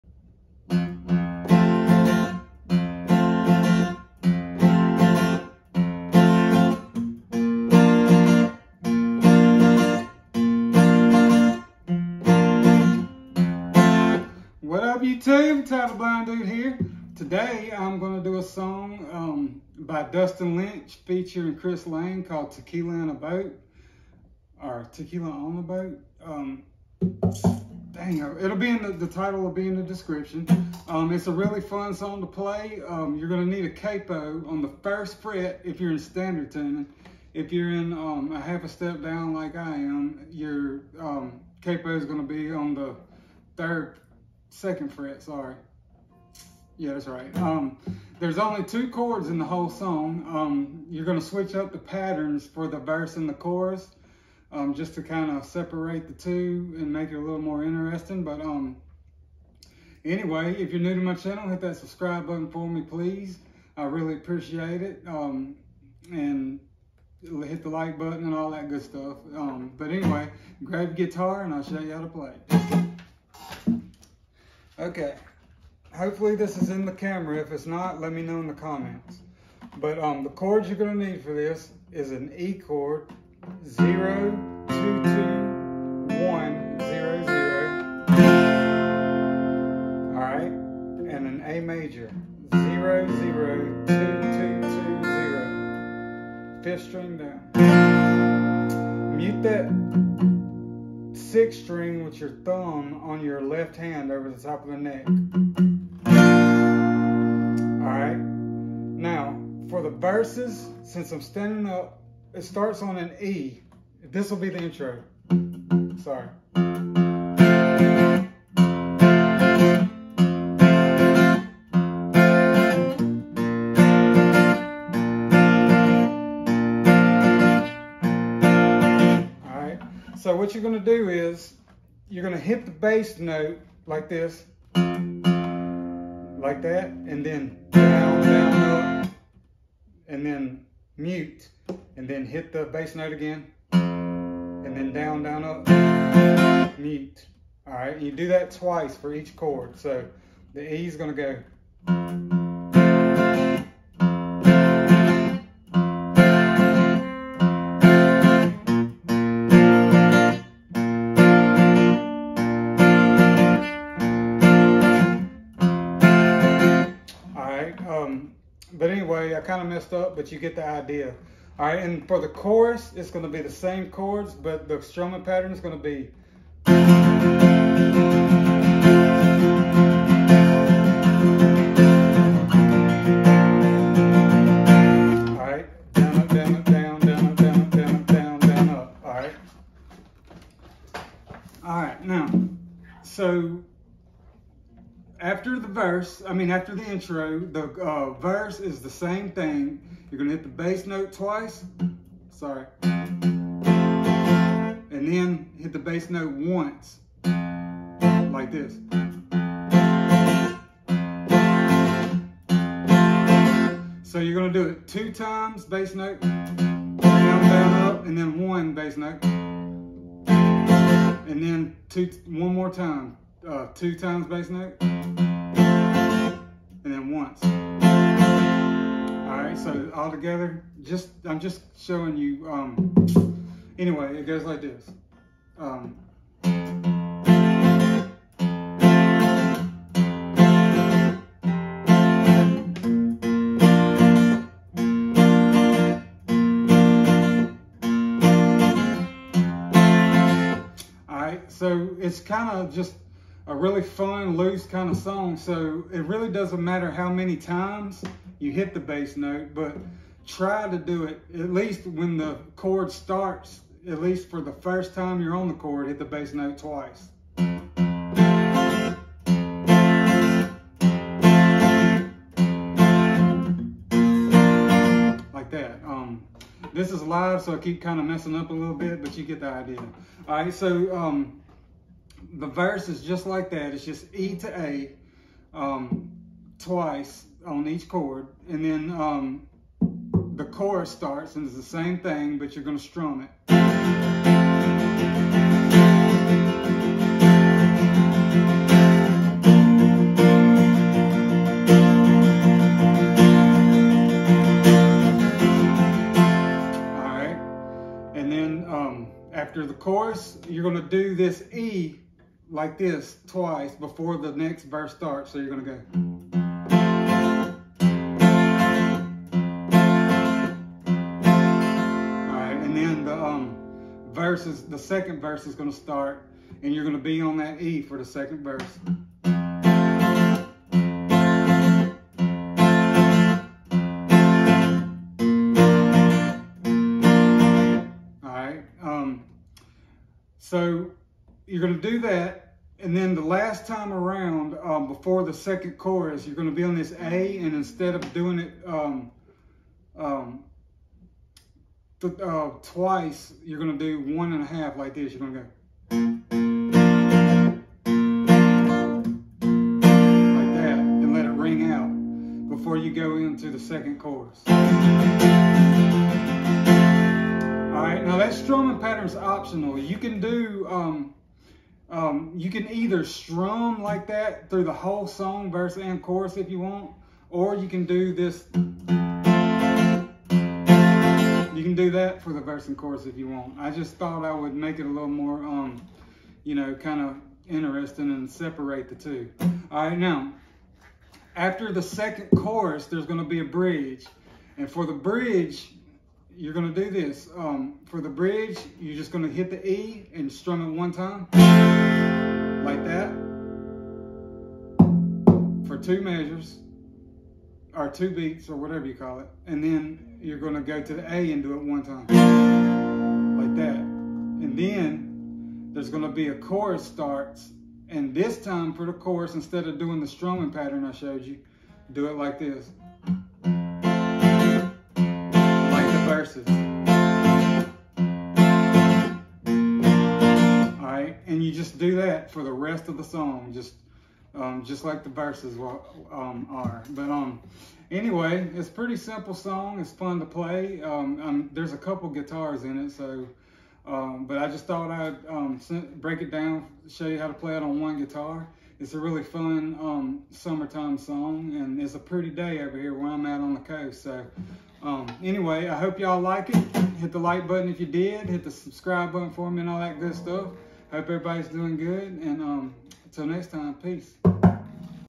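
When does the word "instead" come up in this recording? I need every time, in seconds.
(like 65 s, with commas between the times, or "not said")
347 s, 419 s.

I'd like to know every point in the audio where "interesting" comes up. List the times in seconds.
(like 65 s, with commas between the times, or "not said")
57 s, 387 s.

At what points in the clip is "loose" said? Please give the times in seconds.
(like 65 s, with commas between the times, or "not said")
254 s.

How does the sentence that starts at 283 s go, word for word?
It's just E to A um, twice on each chord.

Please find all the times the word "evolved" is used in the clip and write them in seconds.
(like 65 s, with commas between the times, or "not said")
not said.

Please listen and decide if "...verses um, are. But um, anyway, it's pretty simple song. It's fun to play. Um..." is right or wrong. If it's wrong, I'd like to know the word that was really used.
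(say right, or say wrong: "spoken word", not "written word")
right.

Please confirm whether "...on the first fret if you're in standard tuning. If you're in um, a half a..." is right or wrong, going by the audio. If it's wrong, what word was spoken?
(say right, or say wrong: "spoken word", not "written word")
right.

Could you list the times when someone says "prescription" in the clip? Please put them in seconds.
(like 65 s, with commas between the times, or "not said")
not said.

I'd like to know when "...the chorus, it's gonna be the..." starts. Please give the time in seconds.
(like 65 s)
172 s.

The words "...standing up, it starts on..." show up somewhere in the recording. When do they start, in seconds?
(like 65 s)
111 s.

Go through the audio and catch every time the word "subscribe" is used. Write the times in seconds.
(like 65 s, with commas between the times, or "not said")
61 s, 458 s.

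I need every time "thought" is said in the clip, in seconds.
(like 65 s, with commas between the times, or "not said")
383 s, 444 s.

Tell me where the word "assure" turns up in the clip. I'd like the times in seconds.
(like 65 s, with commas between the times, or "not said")
not said.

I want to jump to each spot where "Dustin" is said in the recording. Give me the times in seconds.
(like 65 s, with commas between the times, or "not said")
20 s.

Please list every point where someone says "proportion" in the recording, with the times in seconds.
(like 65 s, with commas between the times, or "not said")
not said.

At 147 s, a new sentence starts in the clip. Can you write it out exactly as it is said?
All right, you do that twice for each chord.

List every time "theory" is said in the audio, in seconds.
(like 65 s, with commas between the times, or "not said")
not said.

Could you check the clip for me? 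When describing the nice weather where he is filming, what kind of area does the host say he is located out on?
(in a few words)
the coast.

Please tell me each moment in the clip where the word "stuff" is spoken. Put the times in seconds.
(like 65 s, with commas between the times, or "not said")
68 s, 460 s.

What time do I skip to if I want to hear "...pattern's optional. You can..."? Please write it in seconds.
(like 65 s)
368 s.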